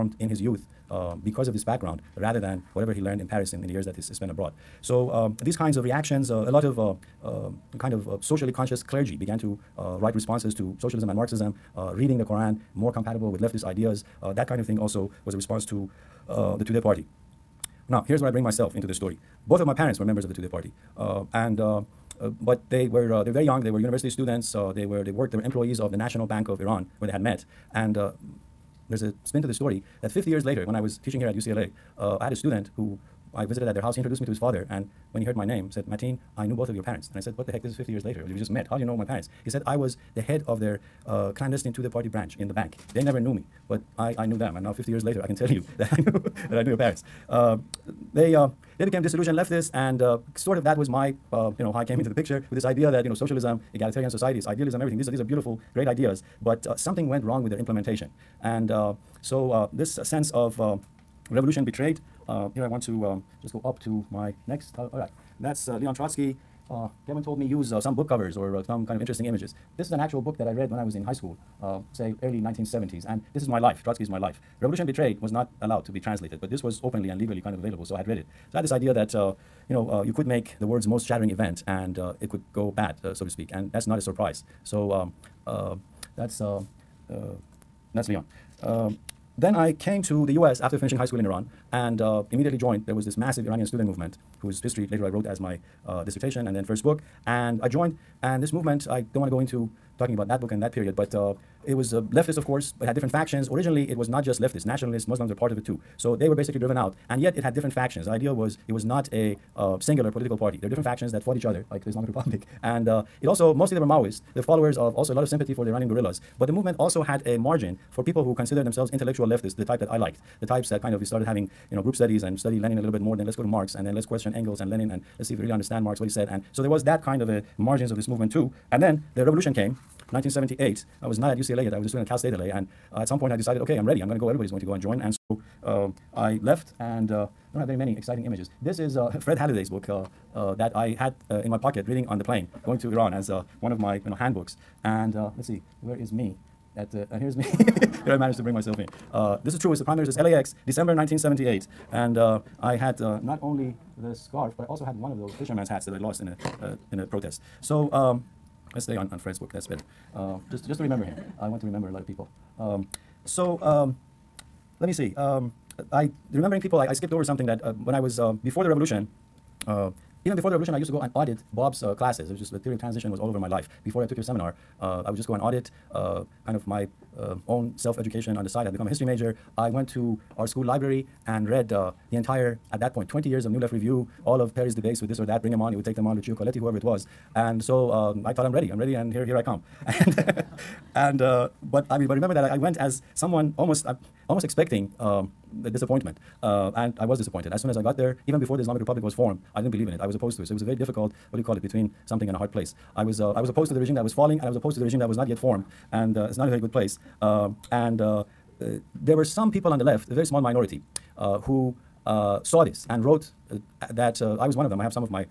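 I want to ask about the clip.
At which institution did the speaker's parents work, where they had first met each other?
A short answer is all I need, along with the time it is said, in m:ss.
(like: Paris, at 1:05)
National Bank of Iran, at 0:25.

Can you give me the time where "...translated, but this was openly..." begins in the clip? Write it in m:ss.
1:15.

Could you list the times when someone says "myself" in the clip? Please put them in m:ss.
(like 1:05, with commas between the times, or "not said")
0:18, 2:28.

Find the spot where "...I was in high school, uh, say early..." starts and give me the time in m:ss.
1:10.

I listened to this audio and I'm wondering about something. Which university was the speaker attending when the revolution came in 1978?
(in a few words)
Cal State LA.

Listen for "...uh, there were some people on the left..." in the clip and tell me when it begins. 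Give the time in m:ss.
3:28.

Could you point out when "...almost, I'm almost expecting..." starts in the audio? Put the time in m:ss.
3:13.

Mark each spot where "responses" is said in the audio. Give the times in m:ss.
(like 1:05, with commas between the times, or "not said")
0:10, 0:15.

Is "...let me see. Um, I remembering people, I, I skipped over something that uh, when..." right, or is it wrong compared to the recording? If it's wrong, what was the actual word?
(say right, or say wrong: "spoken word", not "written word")
right.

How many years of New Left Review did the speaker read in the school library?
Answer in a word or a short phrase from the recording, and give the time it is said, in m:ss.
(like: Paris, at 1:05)
20, at 3:03.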